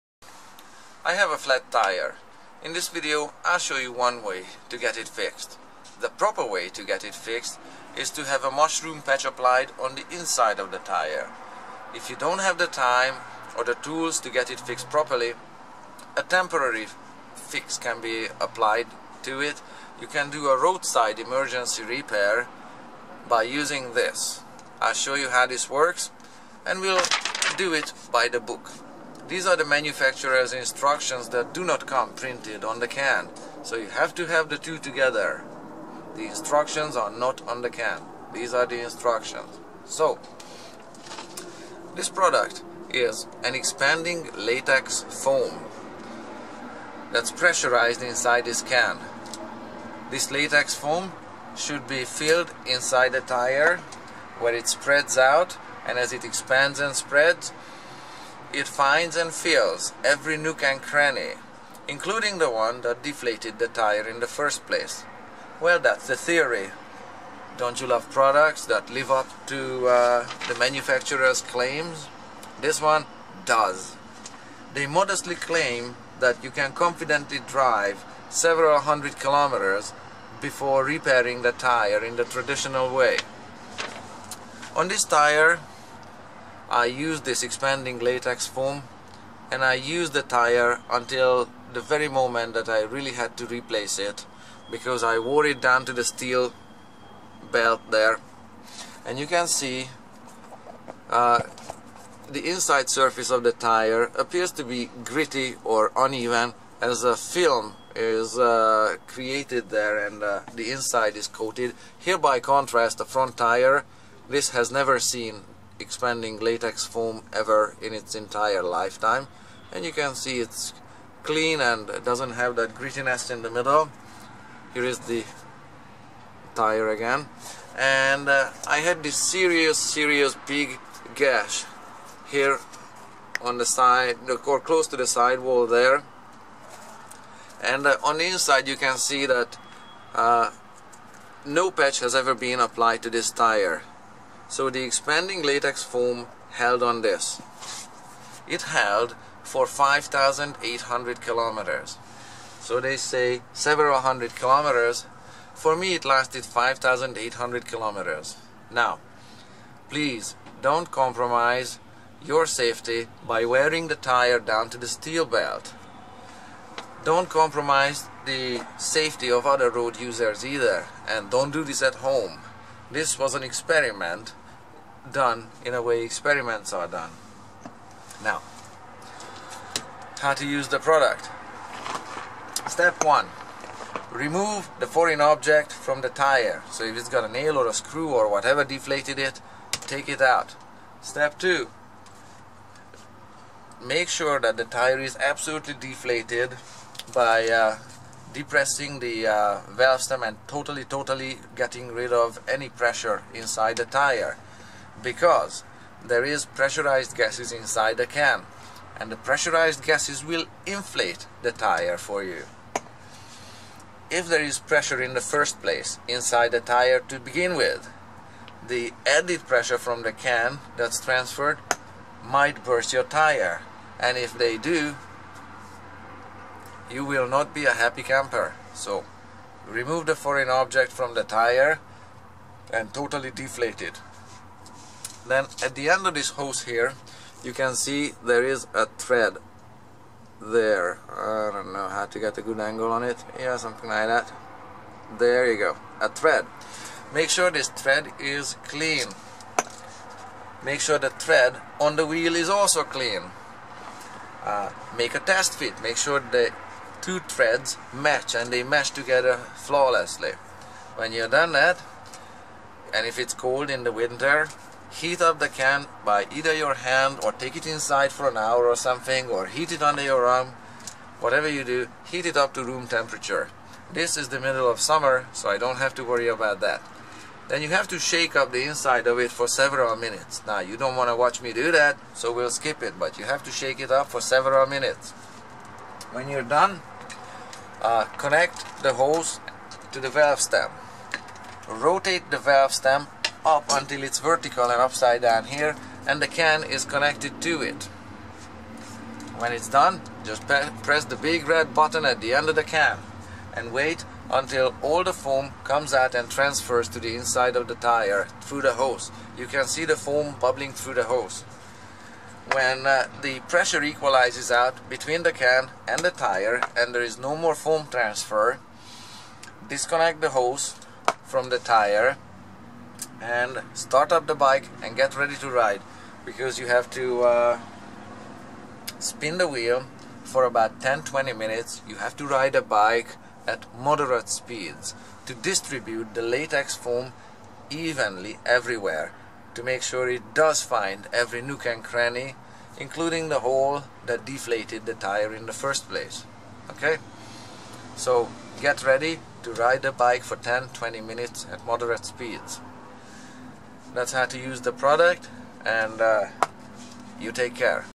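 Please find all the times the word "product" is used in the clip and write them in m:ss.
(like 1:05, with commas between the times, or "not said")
0:42, 1:08, 3:00, 5:54.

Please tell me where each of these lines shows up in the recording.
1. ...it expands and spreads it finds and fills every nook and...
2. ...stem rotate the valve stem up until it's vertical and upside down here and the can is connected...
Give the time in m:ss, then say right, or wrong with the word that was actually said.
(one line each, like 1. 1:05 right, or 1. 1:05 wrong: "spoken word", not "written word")
1. 0:56 right
2. 4:50 right.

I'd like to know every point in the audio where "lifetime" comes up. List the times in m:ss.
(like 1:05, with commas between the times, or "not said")
1:58.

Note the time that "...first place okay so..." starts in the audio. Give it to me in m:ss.
5:45.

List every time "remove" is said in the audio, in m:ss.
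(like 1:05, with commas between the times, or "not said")
3:04, 3:49.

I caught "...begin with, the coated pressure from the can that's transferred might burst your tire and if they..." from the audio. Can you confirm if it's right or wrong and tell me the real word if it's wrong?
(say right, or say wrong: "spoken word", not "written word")
wrong: "added", not "coated".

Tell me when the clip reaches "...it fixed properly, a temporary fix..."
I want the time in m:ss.
0:14.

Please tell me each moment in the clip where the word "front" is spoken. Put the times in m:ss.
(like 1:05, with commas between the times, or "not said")
1:53.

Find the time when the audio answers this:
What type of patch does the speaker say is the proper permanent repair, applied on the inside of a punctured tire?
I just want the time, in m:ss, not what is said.
0:08.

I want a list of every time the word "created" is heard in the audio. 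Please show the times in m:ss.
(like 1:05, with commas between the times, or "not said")
1:49.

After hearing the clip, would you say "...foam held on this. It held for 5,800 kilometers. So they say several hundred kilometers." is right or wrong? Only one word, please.
right.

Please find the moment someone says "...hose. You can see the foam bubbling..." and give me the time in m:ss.
5:08.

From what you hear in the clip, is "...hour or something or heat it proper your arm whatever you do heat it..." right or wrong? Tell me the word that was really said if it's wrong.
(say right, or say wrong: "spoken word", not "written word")
wrong: "under", not "proper".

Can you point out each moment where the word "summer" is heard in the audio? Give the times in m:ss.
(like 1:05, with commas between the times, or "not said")
4:34.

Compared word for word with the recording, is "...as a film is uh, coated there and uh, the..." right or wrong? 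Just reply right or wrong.
wrong.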